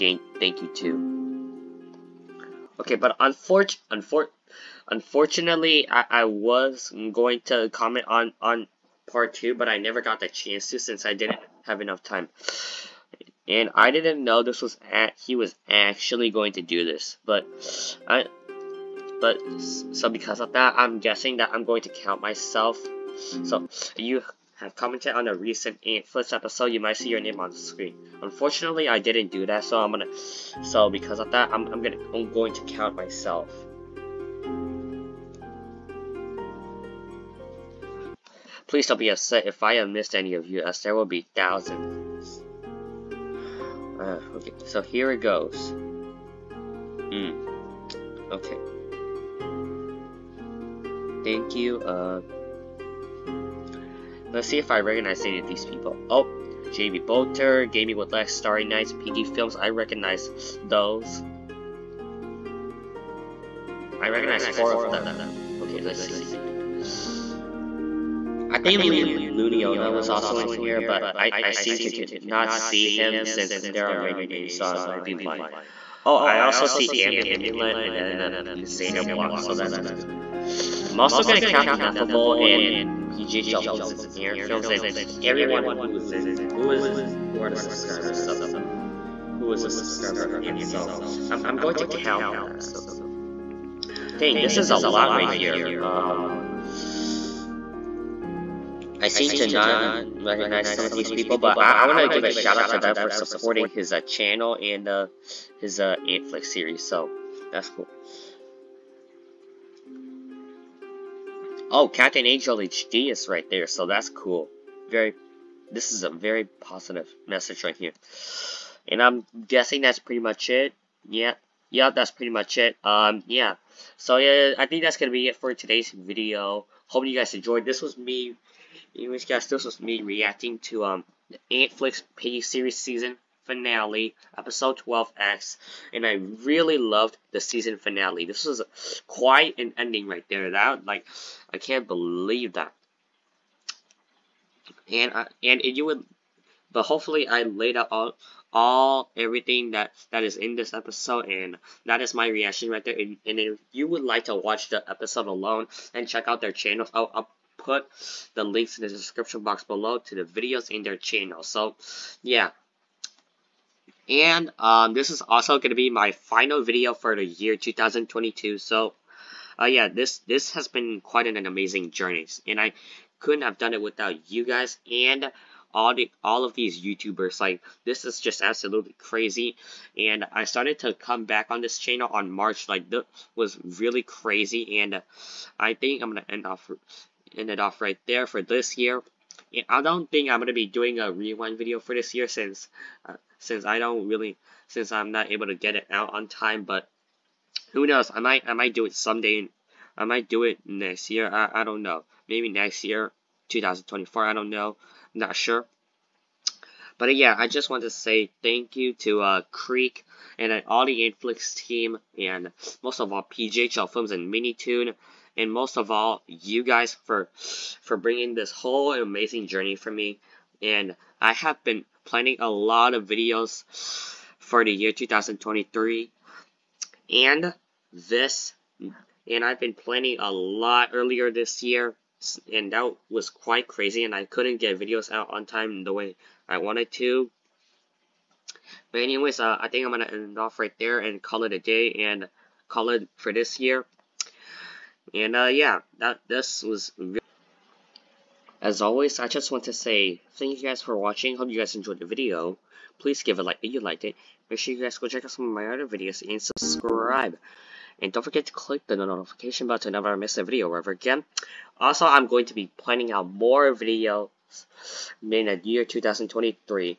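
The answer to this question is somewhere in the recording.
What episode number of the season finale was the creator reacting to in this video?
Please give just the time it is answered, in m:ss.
2:14.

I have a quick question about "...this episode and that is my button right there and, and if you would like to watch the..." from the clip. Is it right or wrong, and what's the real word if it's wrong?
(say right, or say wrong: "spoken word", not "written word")
wrong: "reaction", not "button".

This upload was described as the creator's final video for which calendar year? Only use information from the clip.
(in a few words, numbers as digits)
2022.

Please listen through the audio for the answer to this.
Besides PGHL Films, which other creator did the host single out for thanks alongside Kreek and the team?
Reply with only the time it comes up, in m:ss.
3:34.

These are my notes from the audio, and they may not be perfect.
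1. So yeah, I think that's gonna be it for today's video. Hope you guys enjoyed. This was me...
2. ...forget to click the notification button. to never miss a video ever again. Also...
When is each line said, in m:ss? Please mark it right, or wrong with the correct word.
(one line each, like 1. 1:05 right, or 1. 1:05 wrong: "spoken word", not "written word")
1. 2:03 right
2. 4:18 right.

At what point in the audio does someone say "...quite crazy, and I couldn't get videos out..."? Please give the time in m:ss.
3:53.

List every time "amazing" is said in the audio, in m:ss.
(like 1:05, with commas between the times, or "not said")
2:51, 3:38.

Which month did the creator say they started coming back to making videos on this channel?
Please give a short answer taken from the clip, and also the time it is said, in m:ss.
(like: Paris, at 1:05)
March, at 3:02.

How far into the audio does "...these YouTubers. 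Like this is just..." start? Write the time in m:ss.
2:56.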